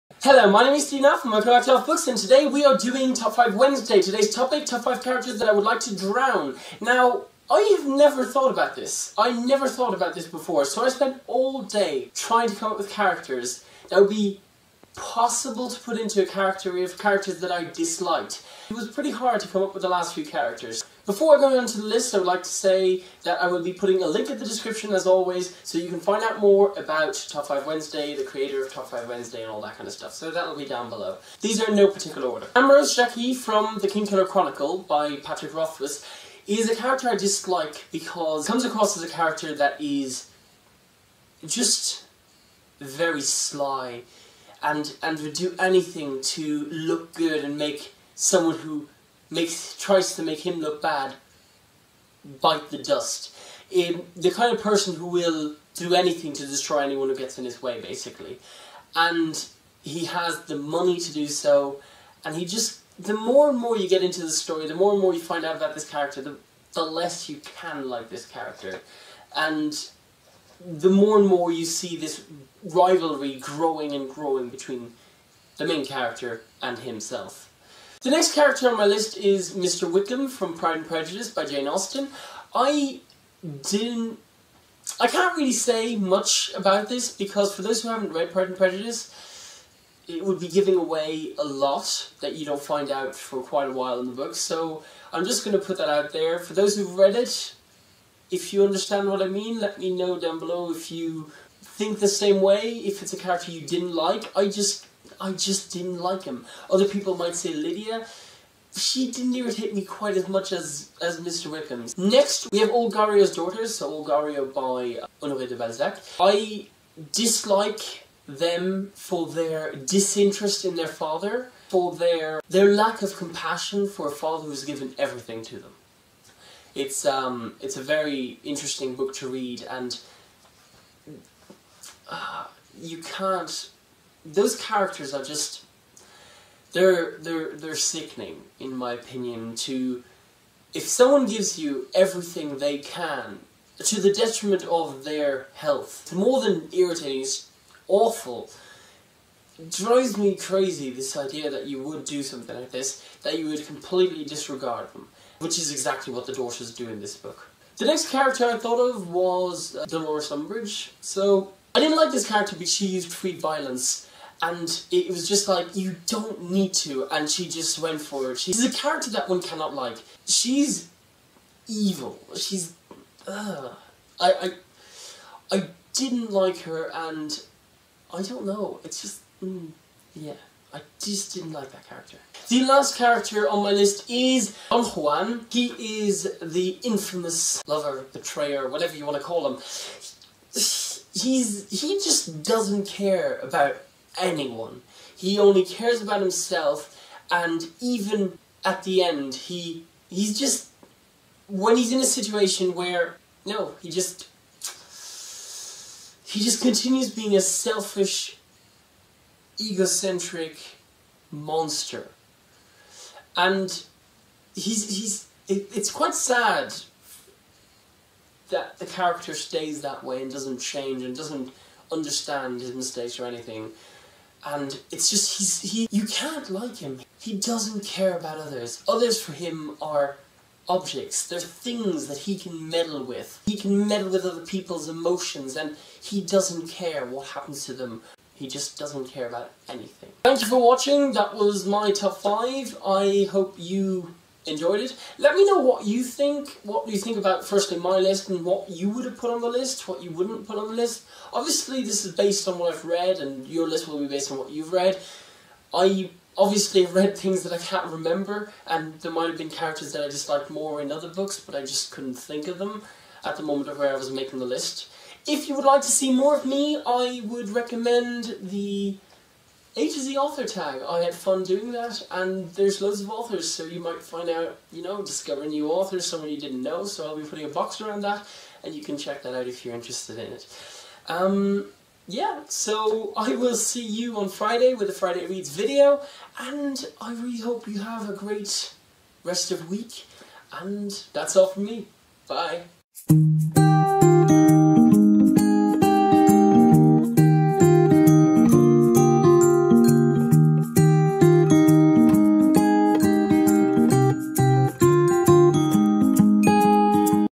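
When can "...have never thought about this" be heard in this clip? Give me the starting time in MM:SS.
00:07.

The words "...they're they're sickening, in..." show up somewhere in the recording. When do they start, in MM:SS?
02:17.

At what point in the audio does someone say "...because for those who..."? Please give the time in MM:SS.
01:27.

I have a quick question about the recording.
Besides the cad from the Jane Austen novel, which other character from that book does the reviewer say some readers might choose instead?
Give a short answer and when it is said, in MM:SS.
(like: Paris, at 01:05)
Lydia, at 01:47.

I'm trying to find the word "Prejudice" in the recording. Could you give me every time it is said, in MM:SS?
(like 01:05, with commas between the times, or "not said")
01:20, 01:28.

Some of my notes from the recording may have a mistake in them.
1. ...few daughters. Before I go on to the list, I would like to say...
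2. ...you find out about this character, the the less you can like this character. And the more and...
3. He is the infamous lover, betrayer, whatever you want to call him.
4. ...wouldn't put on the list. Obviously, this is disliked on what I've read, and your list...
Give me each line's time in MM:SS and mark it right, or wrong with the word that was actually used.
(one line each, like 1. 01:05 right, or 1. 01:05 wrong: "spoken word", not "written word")
1. 00:20 wrong: "characters", not "daughters"
2. 01:05 right
3. 03:05 right
4. 04:10 wrong: "based", not "disliked".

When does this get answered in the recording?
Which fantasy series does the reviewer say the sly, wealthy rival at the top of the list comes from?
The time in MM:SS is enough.
00:33.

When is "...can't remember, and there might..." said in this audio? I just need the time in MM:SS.
04:17.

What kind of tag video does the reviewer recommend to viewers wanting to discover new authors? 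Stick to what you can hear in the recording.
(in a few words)
A to Z author tag.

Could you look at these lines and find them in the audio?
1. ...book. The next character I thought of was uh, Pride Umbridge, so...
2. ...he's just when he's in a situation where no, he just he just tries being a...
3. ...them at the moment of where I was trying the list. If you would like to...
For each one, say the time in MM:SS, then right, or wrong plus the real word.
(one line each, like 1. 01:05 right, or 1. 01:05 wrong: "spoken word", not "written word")
1. 02:37 wrong: "Dolores", not "Pride"
2. 03:20 wrong: "continues", not "tries"
3. 04:22 wrong: "making", not "trying".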